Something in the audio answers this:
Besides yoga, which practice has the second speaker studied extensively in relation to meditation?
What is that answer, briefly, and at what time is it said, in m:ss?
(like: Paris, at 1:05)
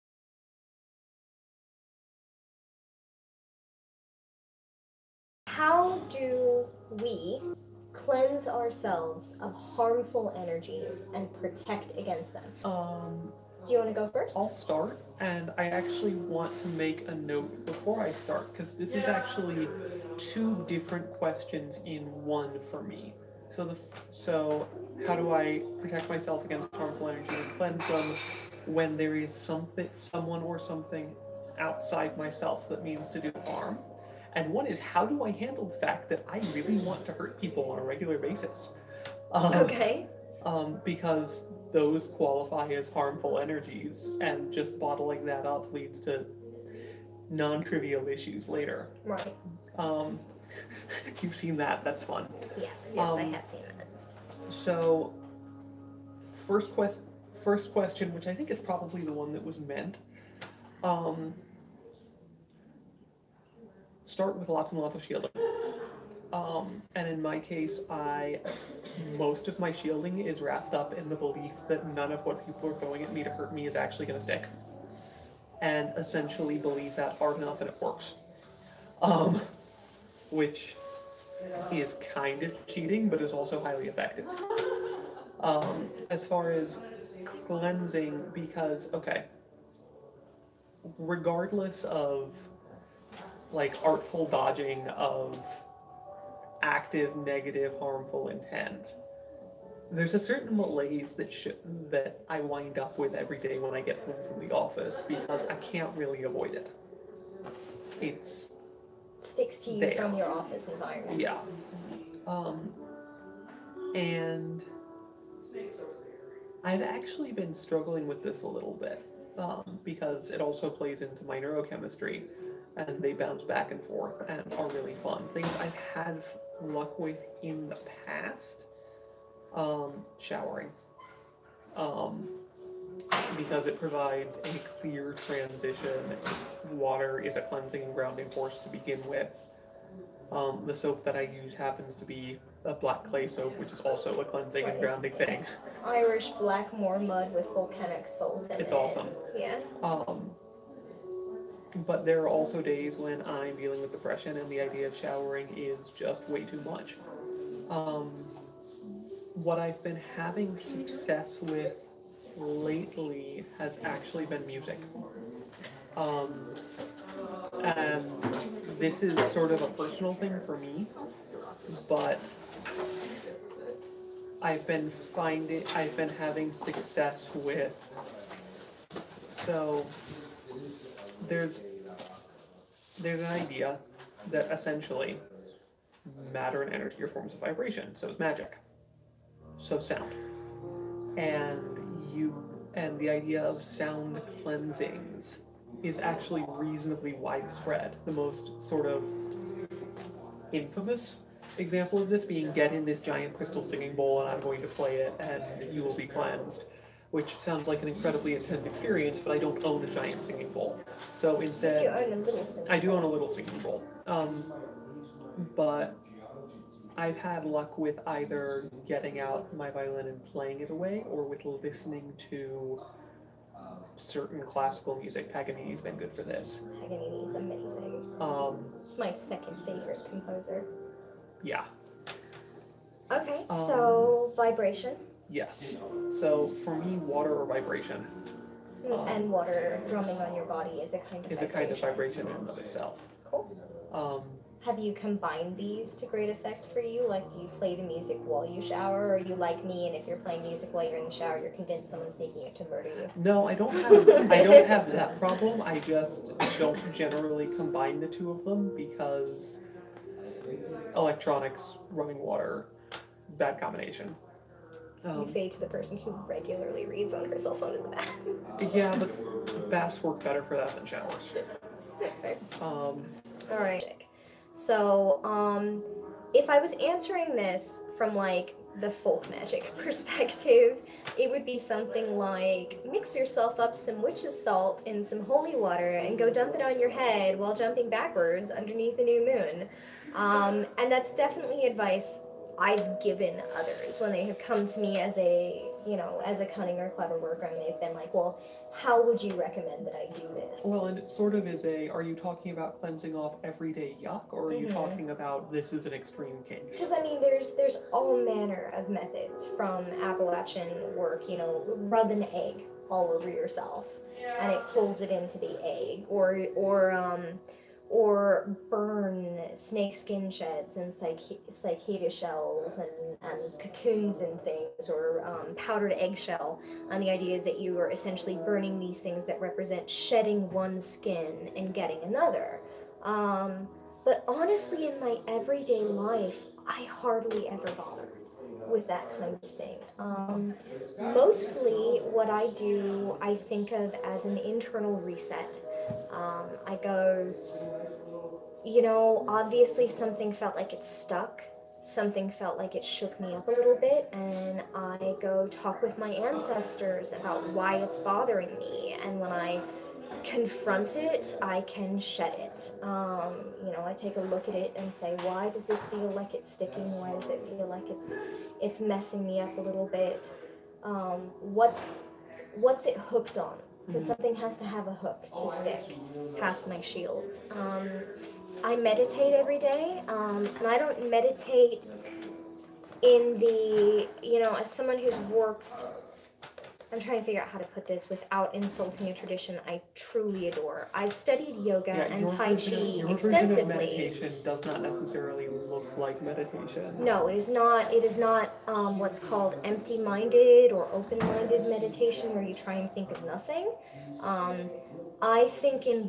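Tai Chi, at 6:32.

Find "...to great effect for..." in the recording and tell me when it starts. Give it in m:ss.
4:05.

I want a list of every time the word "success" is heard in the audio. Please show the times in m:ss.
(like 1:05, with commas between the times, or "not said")
2:40, 2:56.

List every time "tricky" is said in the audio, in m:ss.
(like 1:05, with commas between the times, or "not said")
not said.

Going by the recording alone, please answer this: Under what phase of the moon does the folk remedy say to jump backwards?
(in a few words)
new moon.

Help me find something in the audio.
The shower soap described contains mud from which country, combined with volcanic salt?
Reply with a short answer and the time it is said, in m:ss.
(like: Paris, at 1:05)
Irish, at 2:25.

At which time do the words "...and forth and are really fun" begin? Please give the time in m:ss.
2:03.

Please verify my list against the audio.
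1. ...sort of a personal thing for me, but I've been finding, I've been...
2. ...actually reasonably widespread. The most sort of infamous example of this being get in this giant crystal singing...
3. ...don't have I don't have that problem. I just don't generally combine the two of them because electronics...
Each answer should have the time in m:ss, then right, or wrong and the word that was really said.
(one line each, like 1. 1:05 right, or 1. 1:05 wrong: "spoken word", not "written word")
1. 2:49 right
2. 3:15 right
3. 4:13 right.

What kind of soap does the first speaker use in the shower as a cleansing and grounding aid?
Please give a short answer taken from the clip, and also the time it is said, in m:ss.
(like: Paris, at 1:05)
black clay soap, at 2:22.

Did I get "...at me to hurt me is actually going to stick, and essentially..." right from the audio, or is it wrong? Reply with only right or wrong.
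right.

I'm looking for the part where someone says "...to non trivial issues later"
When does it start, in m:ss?
0:45.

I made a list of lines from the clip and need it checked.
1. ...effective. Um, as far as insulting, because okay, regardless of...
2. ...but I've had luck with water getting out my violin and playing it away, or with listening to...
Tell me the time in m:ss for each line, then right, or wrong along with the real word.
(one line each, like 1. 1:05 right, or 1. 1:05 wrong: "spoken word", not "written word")
1. 1:23 wrong: "cleansing", not "insulting"
2. 3:35 wrong: "either", not "water".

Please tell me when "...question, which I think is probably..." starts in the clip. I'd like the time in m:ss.
0:57.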